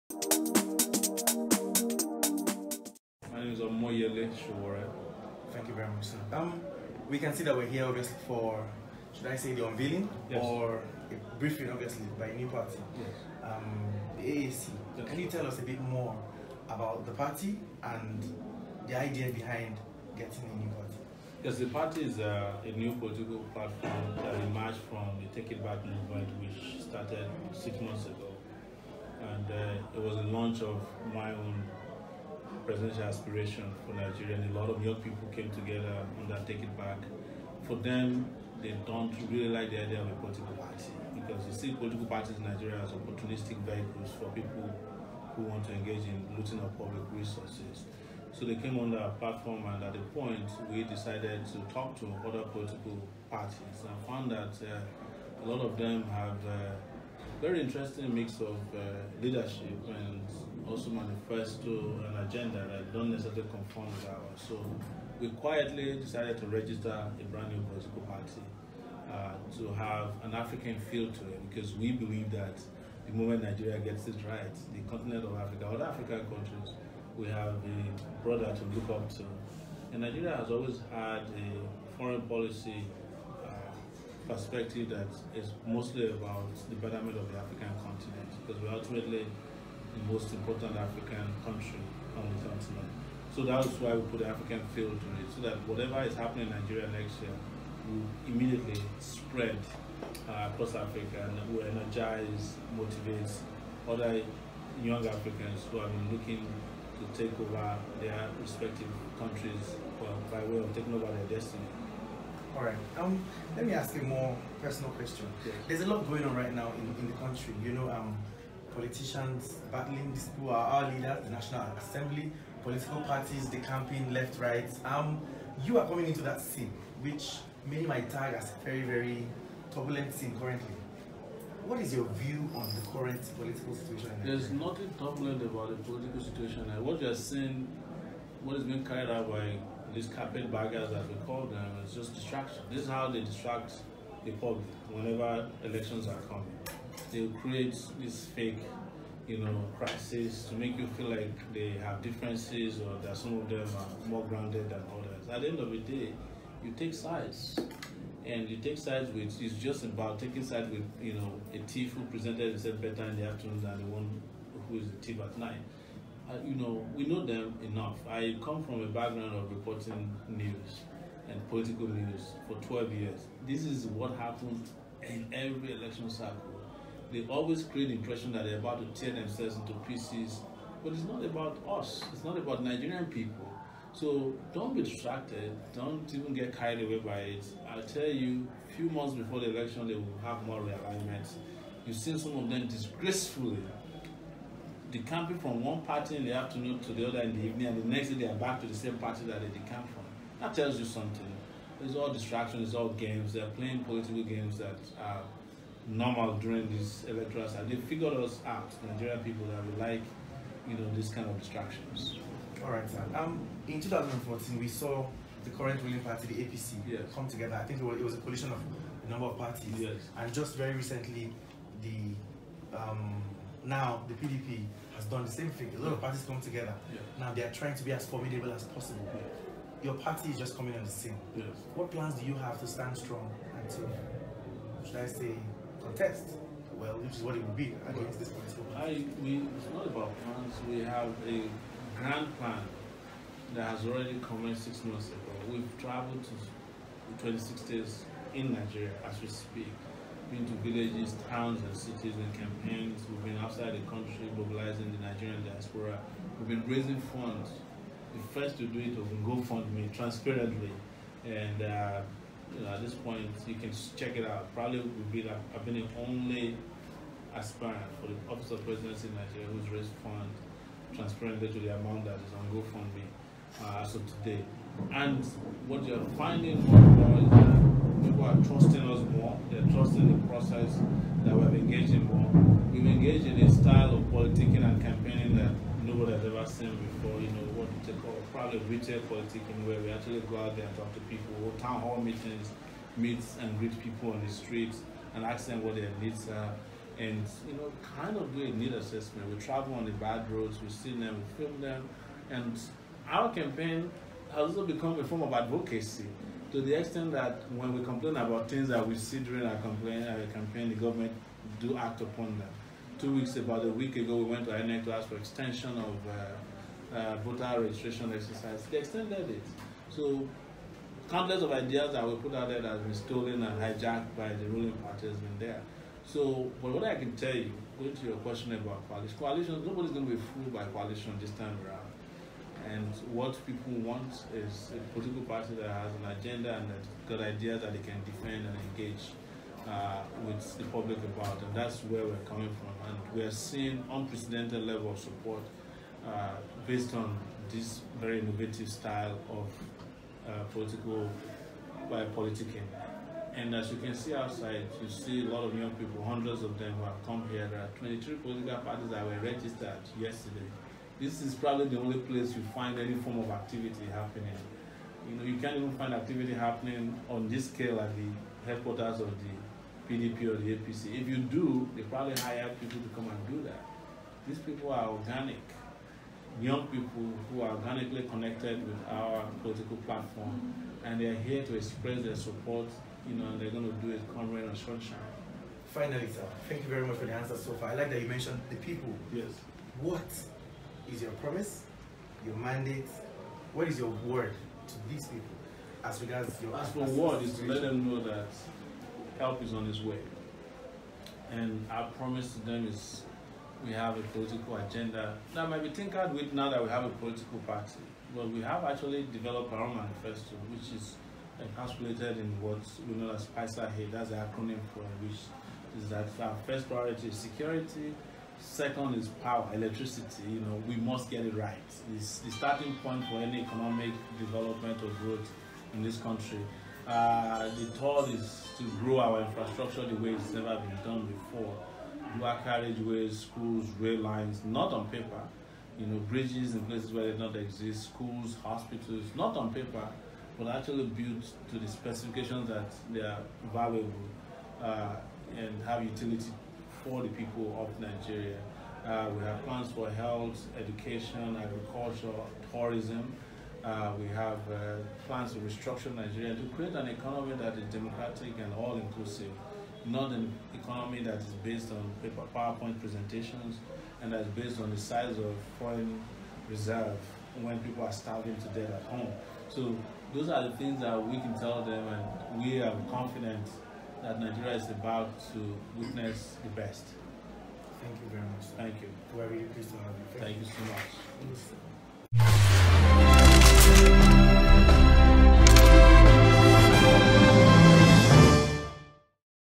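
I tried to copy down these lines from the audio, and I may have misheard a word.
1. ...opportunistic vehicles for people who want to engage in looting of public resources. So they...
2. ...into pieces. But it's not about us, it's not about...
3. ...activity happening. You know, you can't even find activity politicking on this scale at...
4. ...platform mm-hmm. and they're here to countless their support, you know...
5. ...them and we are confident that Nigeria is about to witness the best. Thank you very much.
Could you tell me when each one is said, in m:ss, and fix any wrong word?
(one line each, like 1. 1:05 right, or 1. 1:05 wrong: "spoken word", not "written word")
1. 0:42 right
2. 2:59 right
3. 6:03 wrong: "happening", not "politicking"
4. 6:19 wrong: "express", not "countless"
5. 7:51 right.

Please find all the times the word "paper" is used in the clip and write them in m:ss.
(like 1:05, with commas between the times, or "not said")
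7:14, 7:19, 7:42.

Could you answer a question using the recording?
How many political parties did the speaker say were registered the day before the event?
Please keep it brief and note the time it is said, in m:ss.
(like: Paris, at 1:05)
23, at 5:57.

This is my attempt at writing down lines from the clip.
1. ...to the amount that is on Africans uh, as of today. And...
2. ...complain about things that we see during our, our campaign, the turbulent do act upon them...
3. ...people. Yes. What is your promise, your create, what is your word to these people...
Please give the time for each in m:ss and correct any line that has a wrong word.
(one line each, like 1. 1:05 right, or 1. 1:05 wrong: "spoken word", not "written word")
1. 4:31 wrong: "GoFundMe", not "Africans"
2. 5:07 wrong: "government", not "turbulent"
3. 6:28 wrong: "mandate", not "create".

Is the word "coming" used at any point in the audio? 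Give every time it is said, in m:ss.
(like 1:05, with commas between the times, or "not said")
2:05, 2:26, 3:50, 5:42.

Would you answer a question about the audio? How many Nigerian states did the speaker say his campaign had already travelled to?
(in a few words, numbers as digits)
26.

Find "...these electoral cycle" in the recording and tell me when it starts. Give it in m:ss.
3:26.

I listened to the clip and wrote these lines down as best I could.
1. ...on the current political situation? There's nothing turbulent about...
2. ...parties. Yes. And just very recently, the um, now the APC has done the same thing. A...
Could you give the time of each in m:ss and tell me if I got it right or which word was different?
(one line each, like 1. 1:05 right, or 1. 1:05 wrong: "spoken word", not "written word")
1. 2:12 right
2. 3:39 wrong: "PDP", not "APC".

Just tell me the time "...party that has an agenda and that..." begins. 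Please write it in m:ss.
5:35.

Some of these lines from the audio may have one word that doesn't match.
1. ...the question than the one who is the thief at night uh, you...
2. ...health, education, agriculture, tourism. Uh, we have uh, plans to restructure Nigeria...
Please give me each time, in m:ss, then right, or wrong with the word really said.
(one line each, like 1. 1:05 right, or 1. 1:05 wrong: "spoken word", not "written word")
1. 2:43 wrong: "afternoon", not "question"
2. 7:29 right.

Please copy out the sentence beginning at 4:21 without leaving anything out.
And uh, you know, at this point, you can check it out.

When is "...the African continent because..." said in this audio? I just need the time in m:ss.
1:27.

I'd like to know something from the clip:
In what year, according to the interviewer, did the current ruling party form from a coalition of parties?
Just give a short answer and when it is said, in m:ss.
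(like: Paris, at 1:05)
2014, at 3:33.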